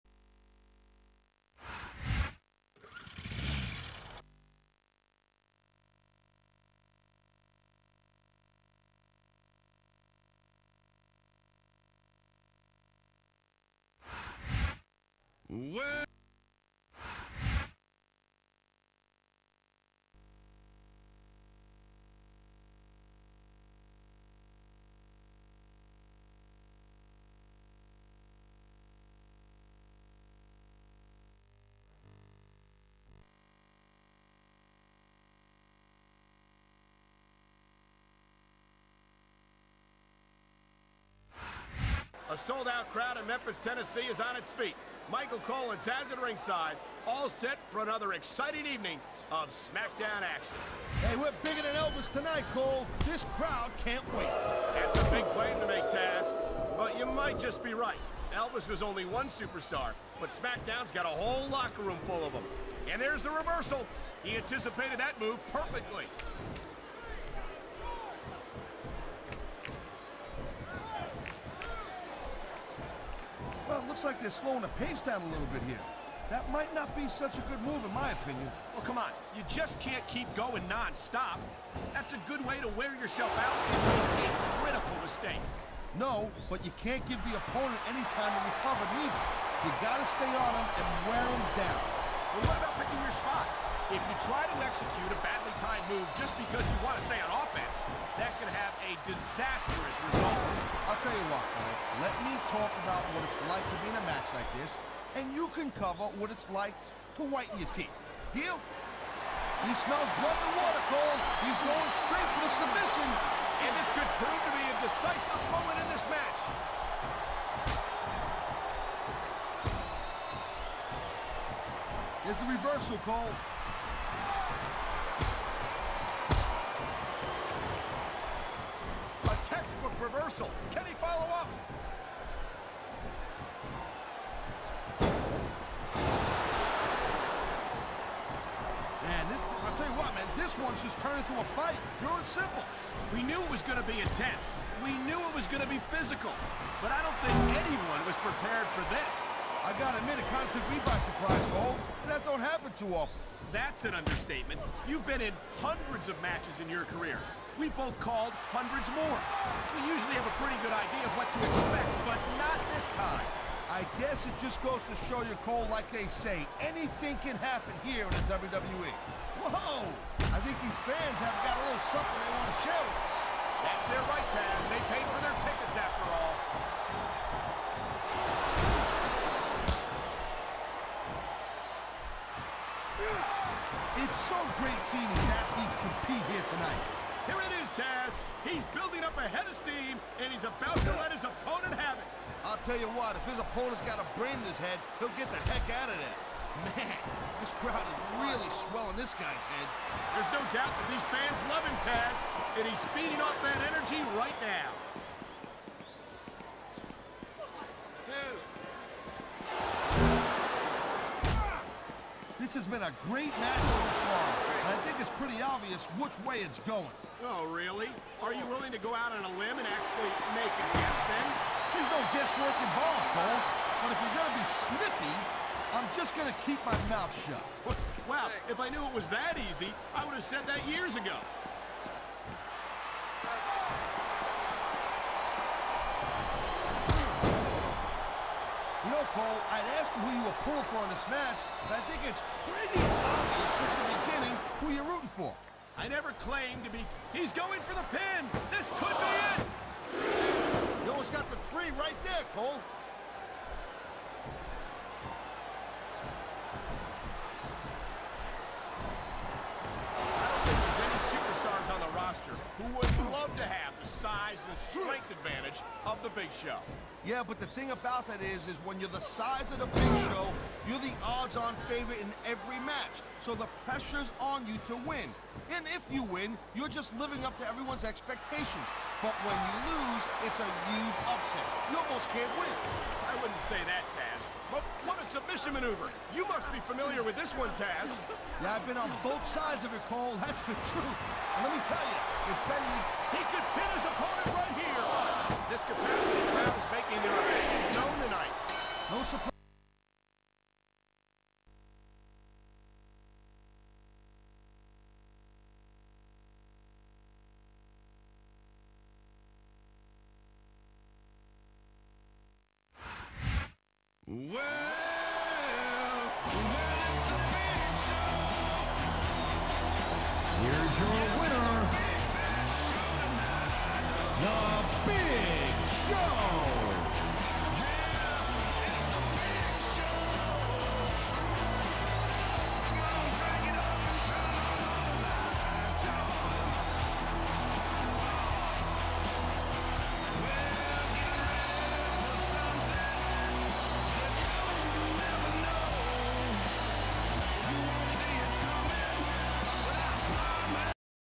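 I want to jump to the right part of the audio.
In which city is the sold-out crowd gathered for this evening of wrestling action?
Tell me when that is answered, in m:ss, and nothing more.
0:43.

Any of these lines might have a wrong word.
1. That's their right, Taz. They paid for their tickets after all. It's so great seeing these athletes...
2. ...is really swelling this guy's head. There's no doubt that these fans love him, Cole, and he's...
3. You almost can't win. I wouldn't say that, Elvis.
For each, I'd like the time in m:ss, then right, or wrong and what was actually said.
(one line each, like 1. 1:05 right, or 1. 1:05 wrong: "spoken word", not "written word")
1. 2:53 right
2. 3:17 wrong: "Taz", not "Cole"
3. 4:41 wrong: "Taz", not "Elvis".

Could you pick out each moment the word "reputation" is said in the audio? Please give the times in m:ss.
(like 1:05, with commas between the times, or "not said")
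not said.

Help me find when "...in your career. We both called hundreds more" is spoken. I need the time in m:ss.
2:36.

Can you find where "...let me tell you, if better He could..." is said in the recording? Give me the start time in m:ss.
4:51.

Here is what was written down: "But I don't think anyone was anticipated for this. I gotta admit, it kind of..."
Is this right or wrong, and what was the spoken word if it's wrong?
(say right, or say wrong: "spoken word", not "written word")
wrong: "prepared", not "anticipated".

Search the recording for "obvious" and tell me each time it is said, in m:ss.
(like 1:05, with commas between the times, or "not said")
3:35, 4:02.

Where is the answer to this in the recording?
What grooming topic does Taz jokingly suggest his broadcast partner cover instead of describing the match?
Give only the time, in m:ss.
1:47.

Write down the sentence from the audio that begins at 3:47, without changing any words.
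Well, wow, if I knew it was that easy, I would have said that years ago.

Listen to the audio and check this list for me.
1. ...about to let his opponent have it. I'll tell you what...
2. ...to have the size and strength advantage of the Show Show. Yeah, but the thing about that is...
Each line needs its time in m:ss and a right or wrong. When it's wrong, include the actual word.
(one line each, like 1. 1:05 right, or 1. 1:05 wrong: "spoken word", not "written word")
1. 3:10 right
2. 4:23 wrong: "Big", not "Show".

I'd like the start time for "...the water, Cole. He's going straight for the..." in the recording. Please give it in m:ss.
1:50.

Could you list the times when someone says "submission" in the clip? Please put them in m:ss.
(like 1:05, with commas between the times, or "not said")
1:52, 4:45.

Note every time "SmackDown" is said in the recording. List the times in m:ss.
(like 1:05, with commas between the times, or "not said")
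0:49, 1:00.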